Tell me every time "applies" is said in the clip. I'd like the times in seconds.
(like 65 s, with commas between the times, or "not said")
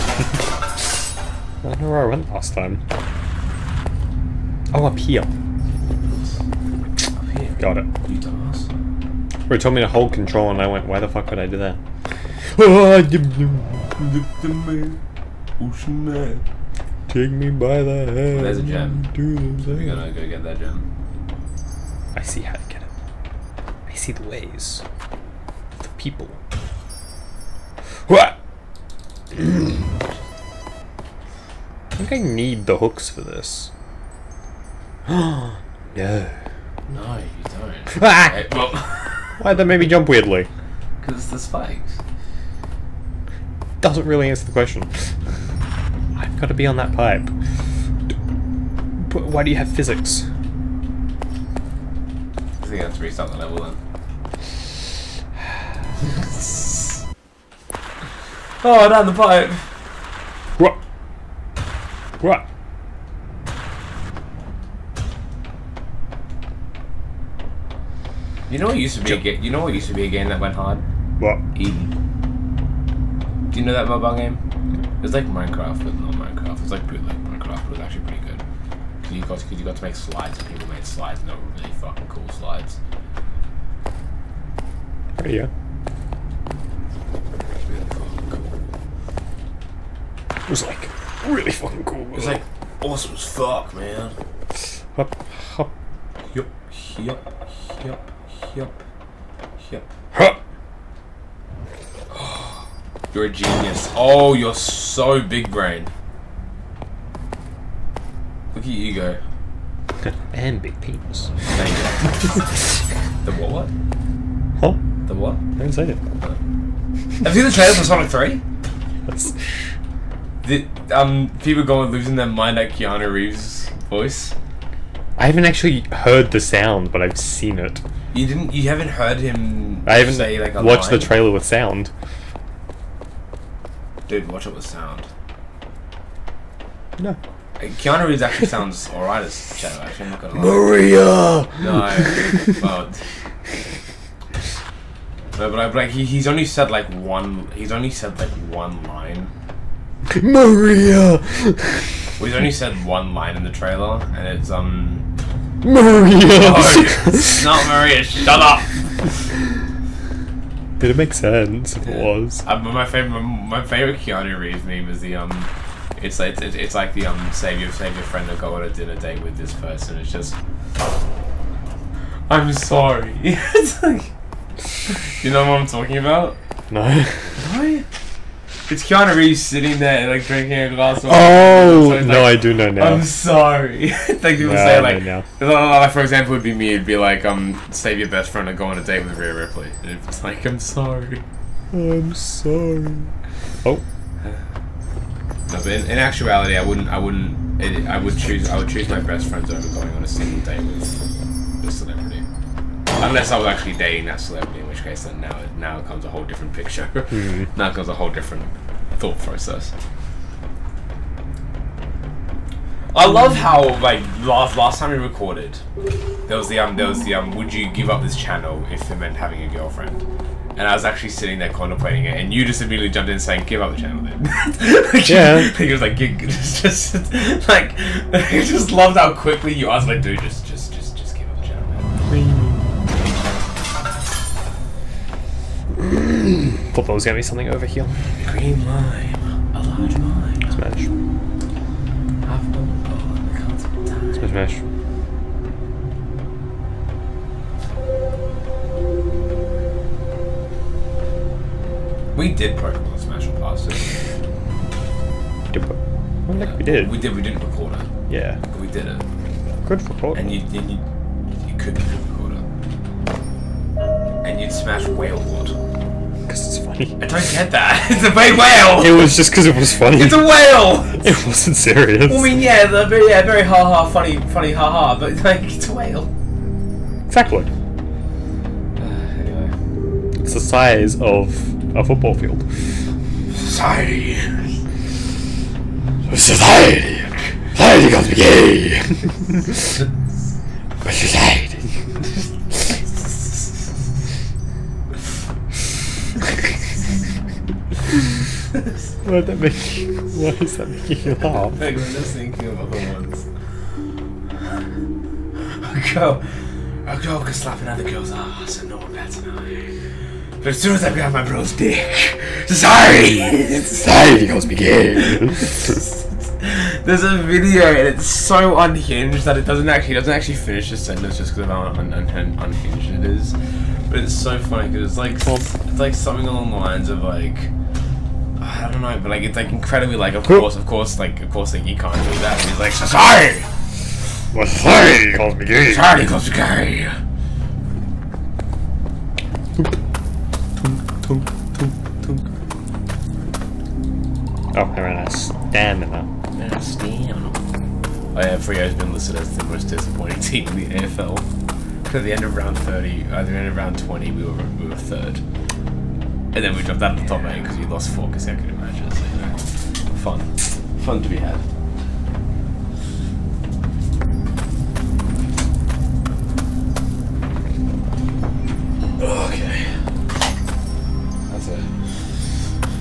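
not said.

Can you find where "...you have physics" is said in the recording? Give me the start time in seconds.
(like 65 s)
49 s.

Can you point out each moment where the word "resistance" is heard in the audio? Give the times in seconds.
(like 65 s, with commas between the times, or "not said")
not said.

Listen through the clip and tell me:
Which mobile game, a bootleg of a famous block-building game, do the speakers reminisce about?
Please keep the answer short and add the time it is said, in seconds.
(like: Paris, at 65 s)
Eden, at 71 s.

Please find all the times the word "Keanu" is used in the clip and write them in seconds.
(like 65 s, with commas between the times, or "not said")
122 s, 137 s, 163 s, 178 s.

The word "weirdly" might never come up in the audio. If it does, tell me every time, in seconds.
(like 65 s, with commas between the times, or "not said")
40 s.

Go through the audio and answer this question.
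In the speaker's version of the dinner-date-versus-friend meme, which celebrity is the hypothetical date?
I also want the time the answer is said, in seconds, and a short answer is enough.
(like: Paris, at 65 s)
Rhea Ripley, at 189 s.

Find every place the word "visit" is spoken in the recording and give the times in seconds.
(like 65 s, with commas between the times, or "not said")
not said.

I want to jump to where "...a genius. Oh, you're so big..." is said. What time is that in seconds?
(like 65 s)
103 s.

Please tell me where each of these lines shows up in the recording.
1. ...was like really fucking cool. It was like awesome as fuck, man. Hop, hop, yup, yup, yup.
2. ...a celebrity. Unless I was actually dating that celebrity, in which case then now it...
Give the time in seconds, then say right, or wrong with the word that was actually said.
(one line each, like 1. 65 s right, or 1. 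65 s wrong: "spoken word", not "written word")
1. 90 s right
2. 201 s right.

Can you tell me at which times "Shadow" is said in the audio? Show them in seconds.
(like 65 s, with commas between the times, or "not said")
139 s.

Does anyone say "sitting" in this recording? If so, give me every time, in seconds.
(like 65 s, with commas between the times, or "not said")
179 s, 221 s.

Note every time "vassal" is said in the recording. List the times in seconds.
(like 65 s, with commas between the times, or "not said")
not said.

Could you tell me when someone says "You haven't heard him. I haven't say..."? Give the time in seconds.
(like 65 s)
128 s.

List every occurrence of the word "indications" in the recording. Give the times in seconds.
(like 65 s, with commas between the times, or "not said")
not said.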